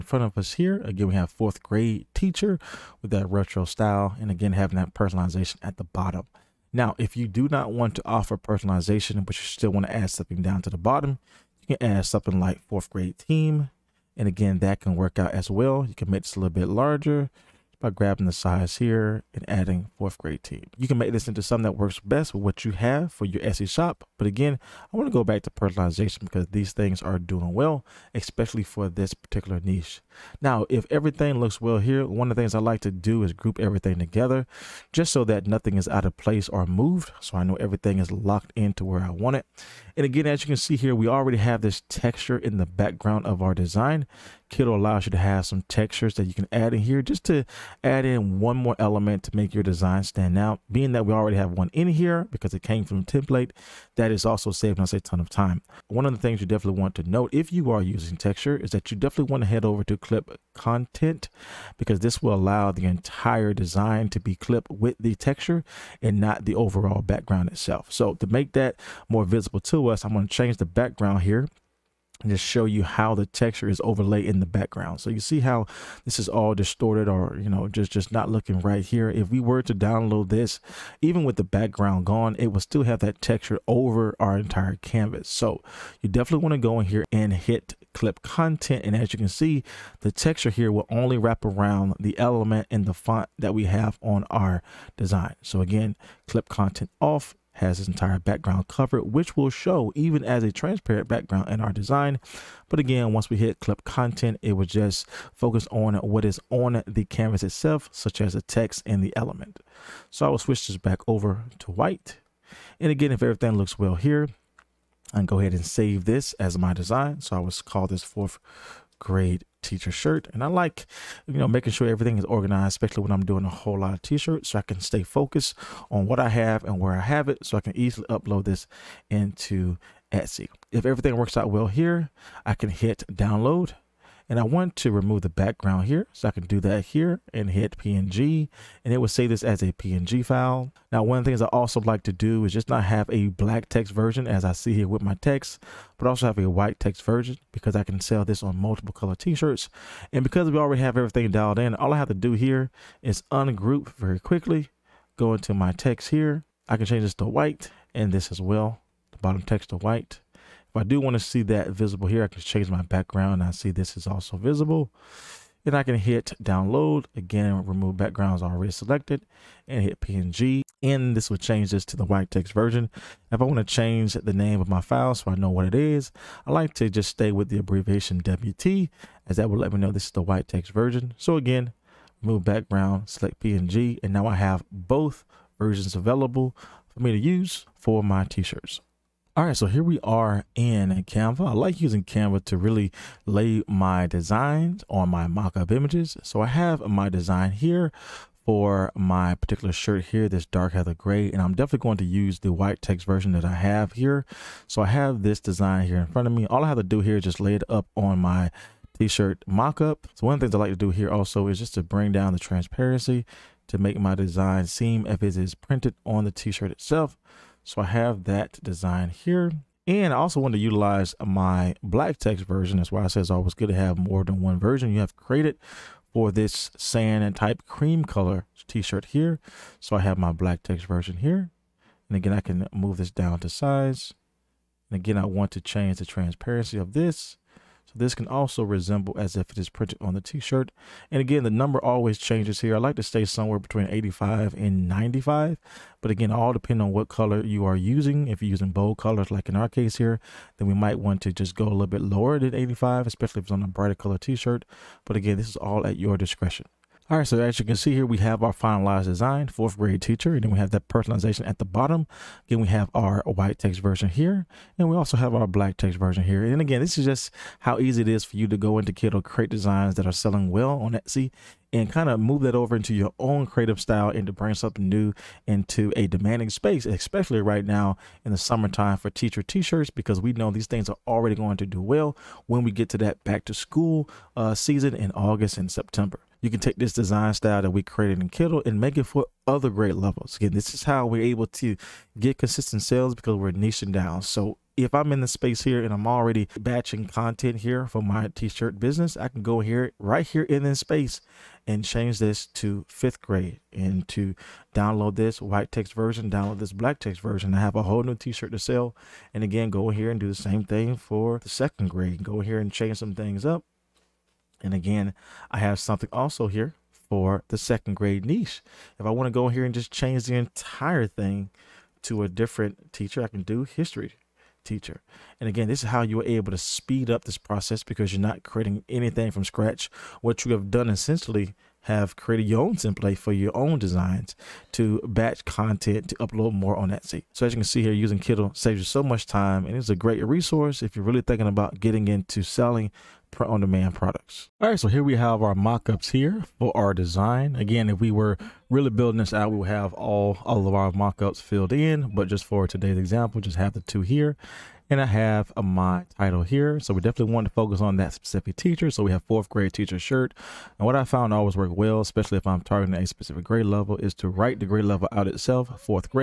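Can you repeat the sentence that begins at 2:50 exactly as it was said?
And this will change this to the white text version.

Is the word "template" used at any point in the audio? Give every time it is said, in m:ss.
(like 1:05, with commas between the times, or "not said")
0:53, 5:32.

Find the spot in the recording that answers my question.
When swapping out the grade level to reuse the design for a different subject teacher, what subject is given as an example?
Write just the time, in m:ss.
5:23.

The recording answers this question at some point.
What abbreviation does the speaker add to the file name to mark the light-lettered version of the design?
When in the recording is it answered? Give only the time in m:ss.
2:58.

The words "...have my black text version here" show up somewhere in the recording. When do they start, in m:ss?
3:49.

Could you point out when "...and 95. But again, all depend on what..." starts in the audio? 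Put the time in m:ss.
4:04.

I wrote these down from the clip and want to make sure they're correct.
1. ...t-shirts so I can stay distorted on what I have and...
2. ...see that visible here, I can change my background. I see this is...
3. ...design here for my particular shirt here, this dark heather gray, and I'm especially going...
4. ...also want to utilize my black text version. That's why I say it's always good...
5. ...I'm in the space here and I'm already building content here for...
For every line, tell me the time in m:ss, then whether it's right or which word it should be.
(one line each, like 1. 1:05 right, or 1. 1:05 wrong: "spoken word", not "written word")
1. 2:04 wrong: "focused", not "distorted"
2. 2:41 right
3. 3:17 wrong: "definitely", not "especially"
4. 3:40 right
5. 4:54 wrong: "batching", not "building".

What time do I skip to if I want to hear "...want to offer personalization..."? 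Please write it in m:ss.
0:07.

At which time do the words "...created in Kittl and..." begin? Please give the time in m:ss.
4:47.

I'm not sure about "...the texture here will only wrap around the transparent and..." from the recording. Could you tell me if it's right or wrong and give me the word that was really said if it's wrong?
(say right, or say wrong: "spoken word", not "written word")
wrong: "element", not "transparent".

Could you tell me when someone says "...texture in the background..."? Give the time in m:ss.
0:41.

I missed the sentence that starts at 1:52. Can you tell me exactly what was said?
And again, if everything looks well here, I can go ahead and save this as my design.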